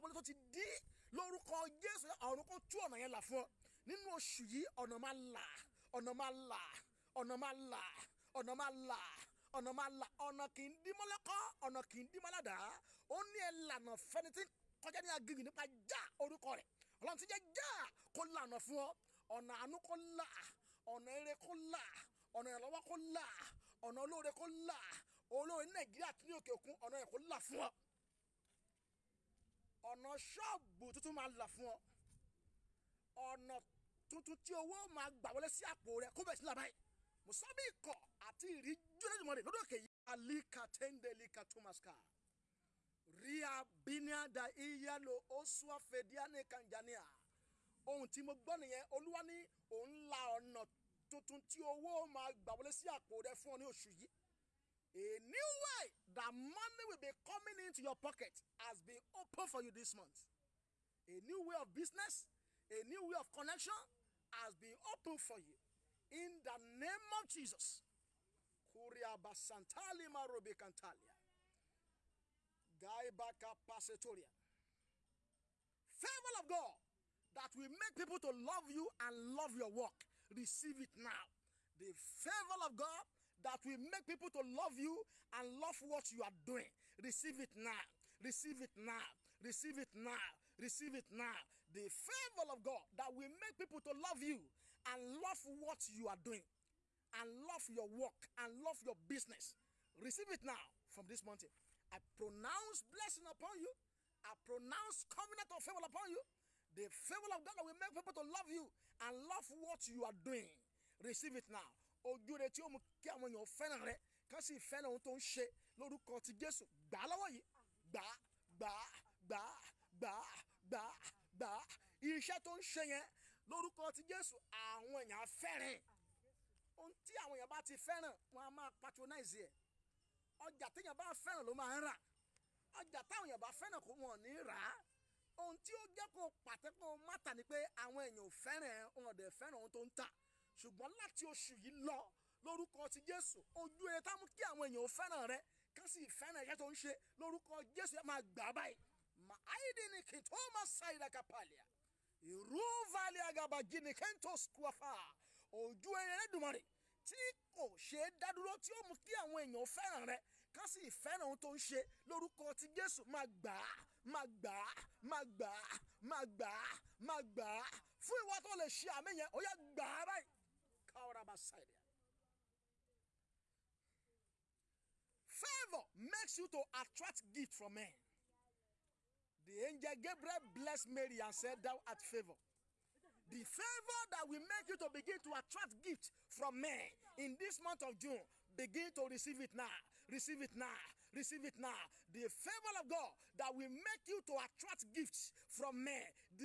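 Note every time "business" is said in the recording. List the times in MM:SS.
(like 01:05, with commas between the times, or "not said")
01:01, 01:38.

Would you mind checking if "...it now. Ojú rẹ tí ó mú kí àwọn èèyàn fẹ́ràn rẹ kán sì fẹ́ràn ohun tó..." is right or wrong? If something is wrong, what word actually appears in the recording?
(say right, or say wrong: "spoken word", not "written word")
right.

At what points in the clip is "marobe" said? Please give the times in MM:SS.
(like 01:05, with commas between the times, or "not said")
01:10.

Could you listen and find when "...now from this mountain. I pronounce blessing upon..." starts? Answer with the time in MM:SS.
01:40.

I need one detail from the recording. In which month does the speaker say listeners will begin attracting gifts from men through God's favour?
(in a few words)
June.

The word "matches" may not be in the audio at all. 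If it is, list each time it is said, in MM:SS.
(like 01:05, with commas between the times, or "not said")
not said.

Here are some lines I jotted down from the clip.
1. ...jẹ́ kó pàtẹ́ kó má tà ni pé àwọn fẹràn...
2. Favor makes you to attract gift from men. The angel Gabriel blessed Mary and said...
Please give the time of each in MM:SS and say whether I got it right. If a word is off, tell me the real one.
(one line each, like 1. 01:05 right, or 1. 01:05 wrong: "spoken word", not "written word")
1. 02:15 wrong: "èèyàn", not "fẹràn"
2. 02:55 right.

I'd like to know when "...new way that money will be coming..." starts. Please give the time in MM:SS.
00:55.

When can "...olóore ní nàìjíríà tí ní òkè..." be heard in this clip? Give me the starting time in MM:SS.
00:25.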